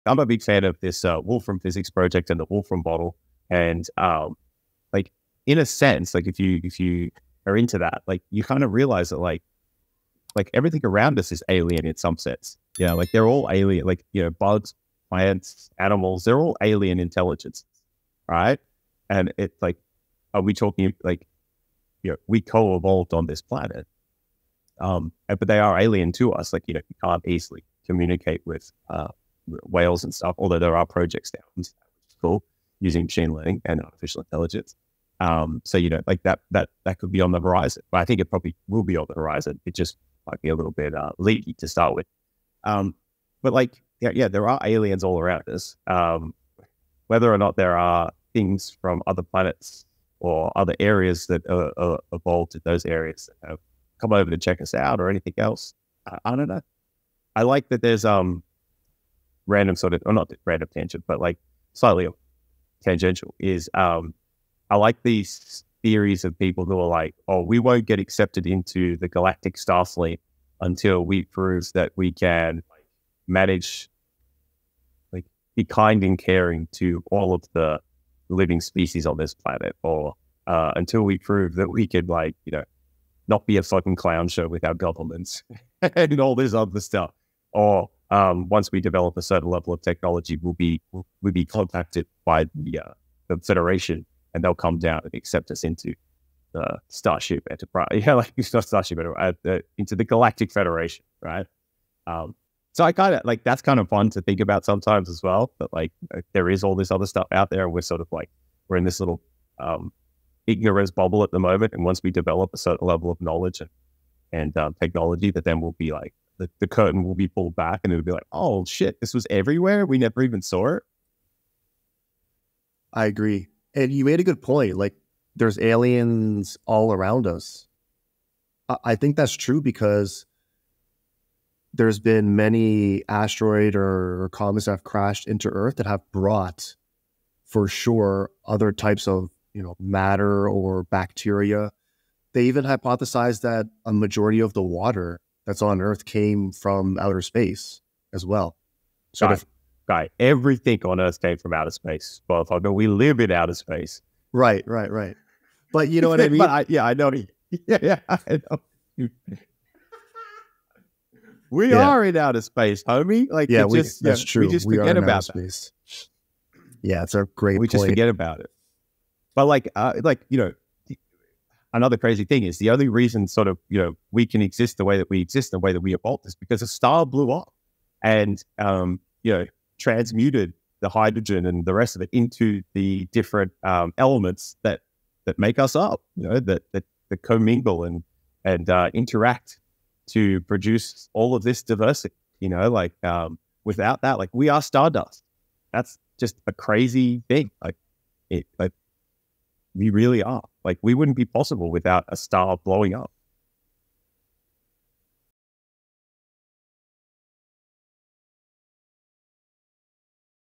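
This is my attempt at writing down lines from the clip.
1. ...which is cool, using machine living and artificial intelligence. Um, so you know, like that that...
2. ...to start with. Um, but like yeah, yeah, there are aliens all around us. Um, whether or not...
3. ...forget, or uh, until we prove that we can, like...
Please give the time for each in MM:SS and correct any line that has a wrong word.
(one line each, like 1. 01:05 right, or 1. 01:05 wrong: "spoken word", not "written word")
1. 00:31 wrong: "learning", not "living"
2. 00:41 right
3. 01:19 wrong: "planet", not "forget".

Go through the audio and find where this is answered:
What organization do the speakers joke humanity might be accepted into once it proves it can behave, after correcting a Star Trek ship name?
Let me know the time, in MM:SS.
01:40.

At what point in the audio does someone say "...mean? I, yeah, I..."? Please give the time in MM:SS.
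02:36.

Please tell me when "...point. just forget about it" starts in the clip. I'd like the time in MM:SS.
02:47.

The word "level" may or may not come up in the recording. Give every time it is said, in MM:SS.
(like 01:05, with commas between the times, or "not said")
01:29, 01:52.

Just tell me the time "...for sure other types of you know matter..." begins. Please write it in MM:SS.
02:17.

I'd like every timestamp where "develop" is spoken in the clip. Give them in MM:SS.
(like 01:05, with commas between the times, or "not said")
01:28, 01:52.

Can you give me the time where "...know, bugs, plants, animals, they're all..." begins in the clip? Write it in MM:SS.
00:14.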